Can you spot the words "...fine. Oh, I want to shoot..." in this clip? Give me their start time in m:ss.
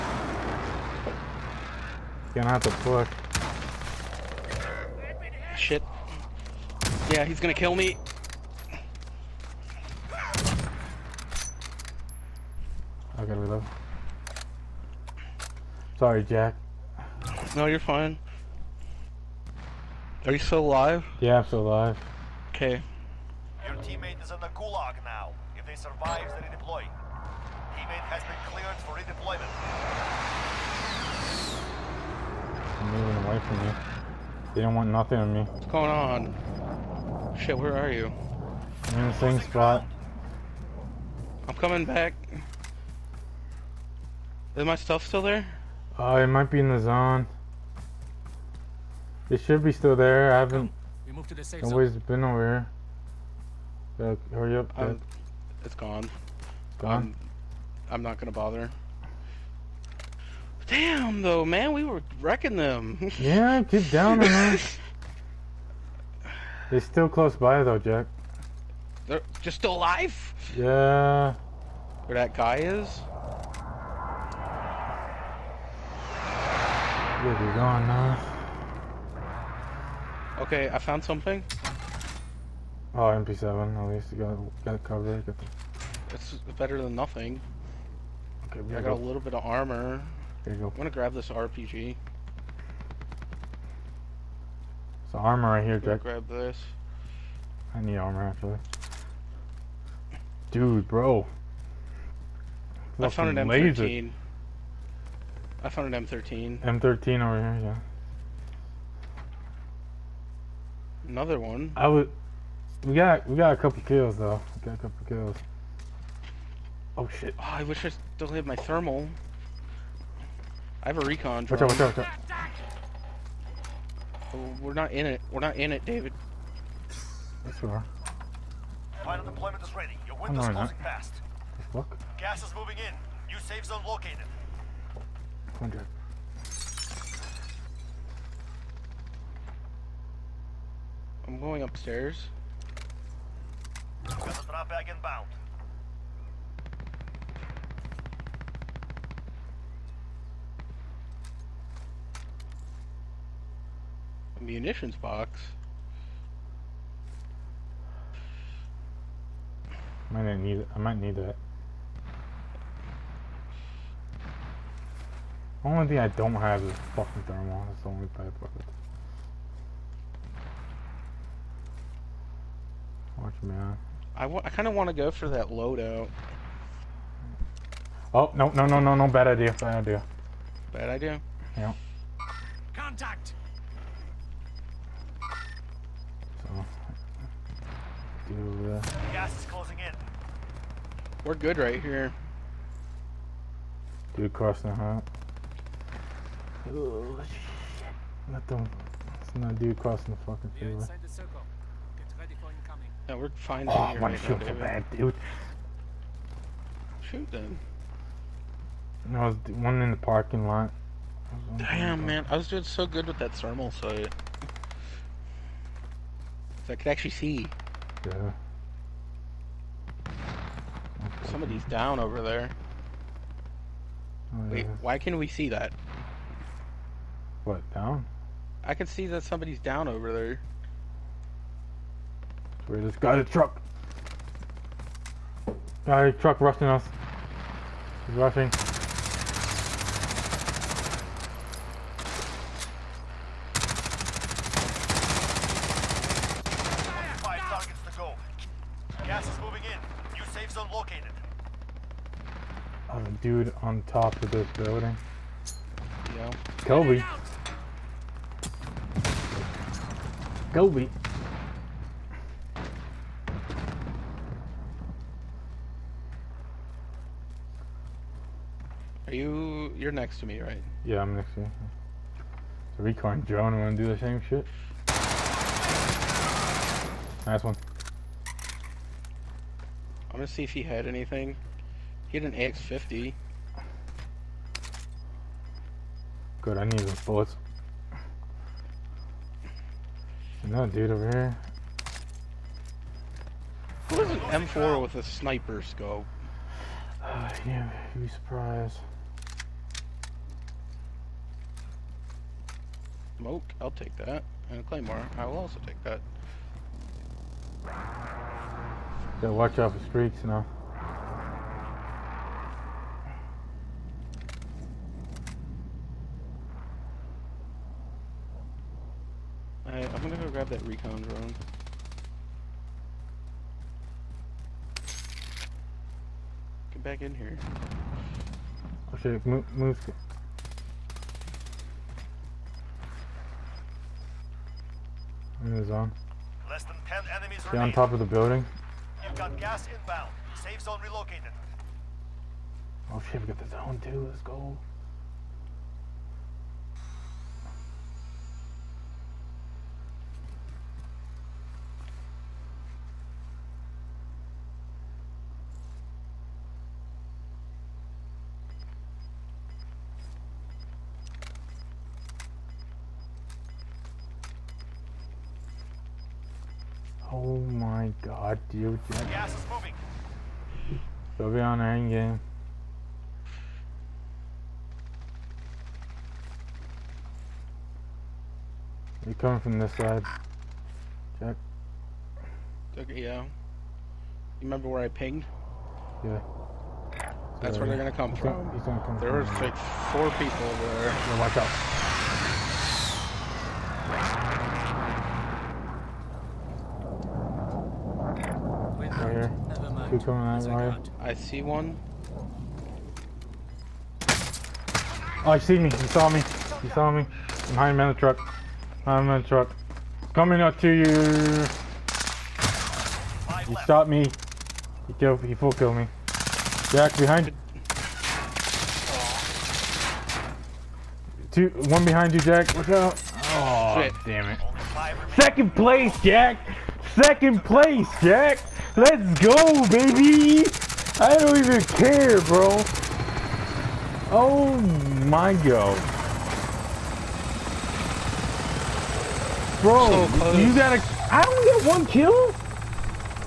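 3:23.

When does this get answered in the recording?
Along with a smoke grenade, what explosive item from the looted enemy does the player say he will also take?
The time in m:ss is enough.
5:04.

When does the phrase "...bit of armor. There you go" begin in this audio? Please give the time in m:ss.
1:29.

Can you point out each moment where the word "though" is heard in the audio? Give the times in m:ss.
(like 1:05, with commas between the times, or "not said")
1:01, 1:07, 1:54.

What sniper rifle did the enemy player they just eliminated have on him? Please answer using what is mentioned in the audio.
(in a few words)
AX-50.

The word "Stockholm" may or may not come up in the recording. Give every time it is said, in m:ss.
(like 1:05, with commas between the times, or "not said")
not said.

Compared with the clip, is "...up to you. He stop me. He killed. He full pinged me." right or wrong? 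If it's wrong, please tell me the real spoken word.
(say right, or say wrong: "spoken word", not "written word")
wrong: "killed", not "pinged".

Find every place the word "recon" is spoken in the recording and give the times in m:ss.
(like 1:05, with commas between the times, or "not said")
2:01, 4:32, 5:20.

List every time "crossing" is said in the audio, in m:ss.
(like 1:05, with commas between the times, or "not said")
3:14, 3:19.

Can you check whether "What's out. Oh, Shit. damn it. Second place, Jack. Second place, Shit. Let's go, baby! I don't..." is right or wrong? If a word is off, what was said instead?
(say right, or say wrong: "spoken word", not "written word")
wrong: "Jack", not "Shit".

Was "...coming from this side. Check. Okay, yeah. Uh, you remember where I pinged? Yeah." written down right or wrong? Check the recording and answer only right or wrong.
right.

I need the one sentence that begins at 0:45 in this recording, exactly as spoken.
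Uh, it might be in the zone.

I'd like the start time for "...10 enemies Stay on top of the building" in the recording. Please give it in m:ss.
5:36.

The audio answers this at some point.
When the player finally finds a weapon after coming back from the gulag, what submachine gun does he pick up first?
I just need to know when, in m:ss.
1:22.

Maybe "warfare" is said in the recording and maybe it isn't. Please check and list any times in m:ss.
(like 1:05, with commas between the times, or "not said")
not said.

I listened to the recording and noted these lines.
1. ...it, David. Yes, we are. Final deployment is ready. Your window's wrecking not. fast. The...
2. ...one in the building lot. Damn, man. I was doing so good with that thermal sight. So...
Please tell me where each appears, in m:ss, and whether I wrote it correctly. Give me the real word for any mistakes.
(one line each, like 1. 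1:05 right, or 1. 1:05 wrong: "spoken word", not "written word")
1. 2:05 wrong: "closing", not "wrecking"
2. 3:29 wrong: "parking", not "building".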